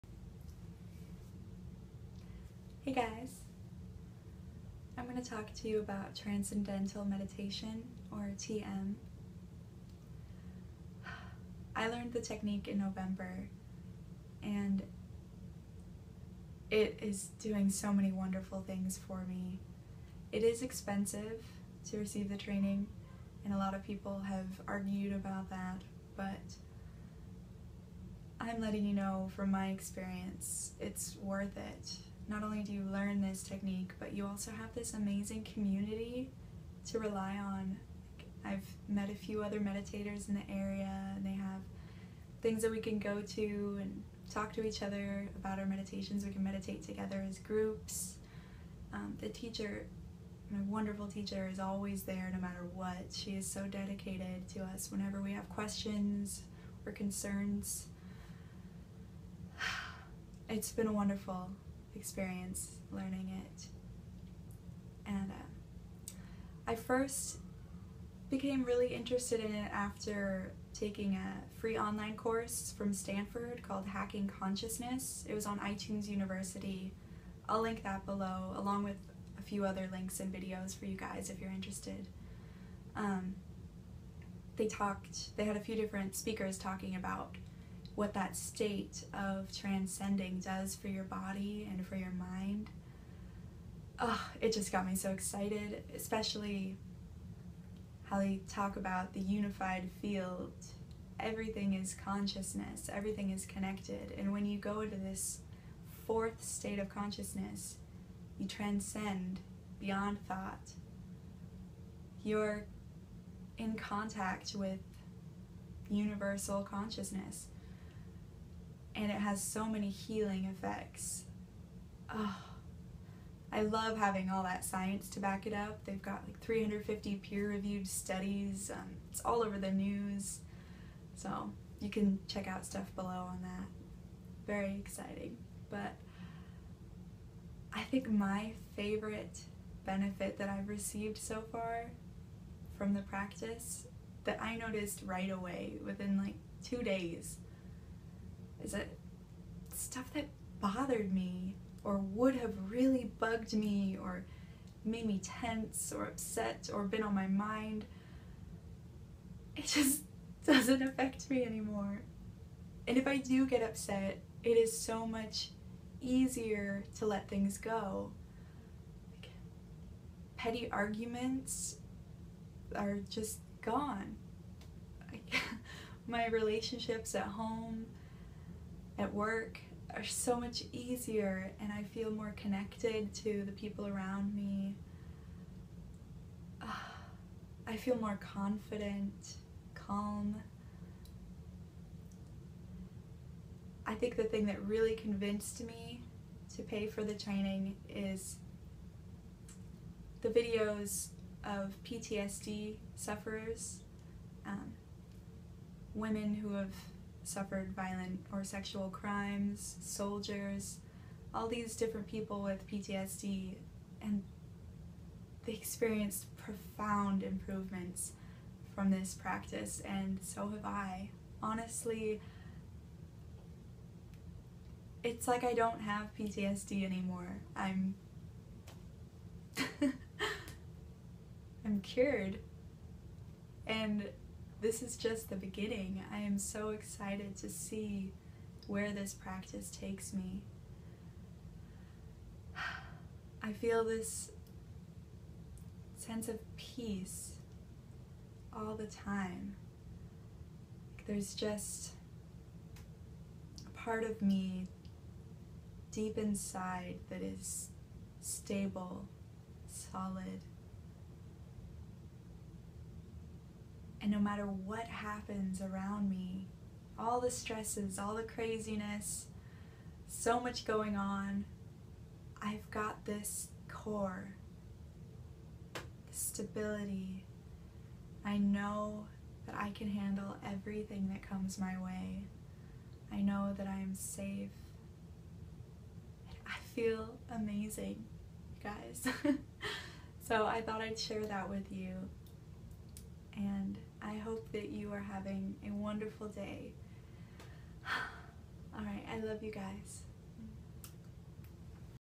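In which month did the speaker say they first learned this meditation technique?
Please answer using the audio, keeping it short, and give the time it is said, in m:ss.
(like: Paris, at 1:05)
November, at 0:12.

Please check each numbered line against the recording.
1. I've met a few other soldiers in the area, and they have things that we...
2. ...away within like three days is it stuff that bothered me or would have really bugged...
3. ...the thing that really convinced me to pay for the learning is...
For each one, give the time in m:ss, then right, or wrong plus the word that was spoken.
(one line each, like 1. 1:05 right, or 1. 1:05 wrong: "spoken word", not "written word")
1. 0:38 wrong: "meditators", not "soldiers"
2. 2:25 wrong: "two", not "three"
3. 3:14 wrong: "training", not "learning".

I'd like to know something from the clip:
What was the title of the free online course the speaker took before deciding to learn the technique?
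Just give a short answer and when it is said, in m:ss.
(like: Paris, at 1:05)
Hacking Consciousness, at 1:13.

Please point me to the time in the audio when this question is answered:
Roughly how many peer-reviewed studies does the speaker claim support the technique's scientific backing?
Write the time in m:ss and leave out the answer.
2:06.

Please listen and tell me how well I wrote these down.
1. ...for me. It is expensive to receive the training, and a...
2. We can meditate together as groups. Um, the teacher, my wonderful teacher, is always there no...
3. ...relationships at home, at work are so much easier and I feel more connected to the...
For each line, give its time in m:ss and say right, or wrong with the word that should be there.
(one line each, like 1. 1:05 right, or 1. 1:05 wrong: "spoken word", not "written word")
1. 0:19 right
2. 0:46 right
3. 2:56 right.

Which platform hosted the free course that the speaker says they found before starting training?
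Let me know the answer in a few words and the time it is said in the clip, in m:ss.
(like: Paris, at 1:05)
iTunes University, at 1:15.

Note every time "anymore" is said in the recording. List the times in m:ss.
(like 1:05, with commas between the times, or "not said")
2:41, 3:46.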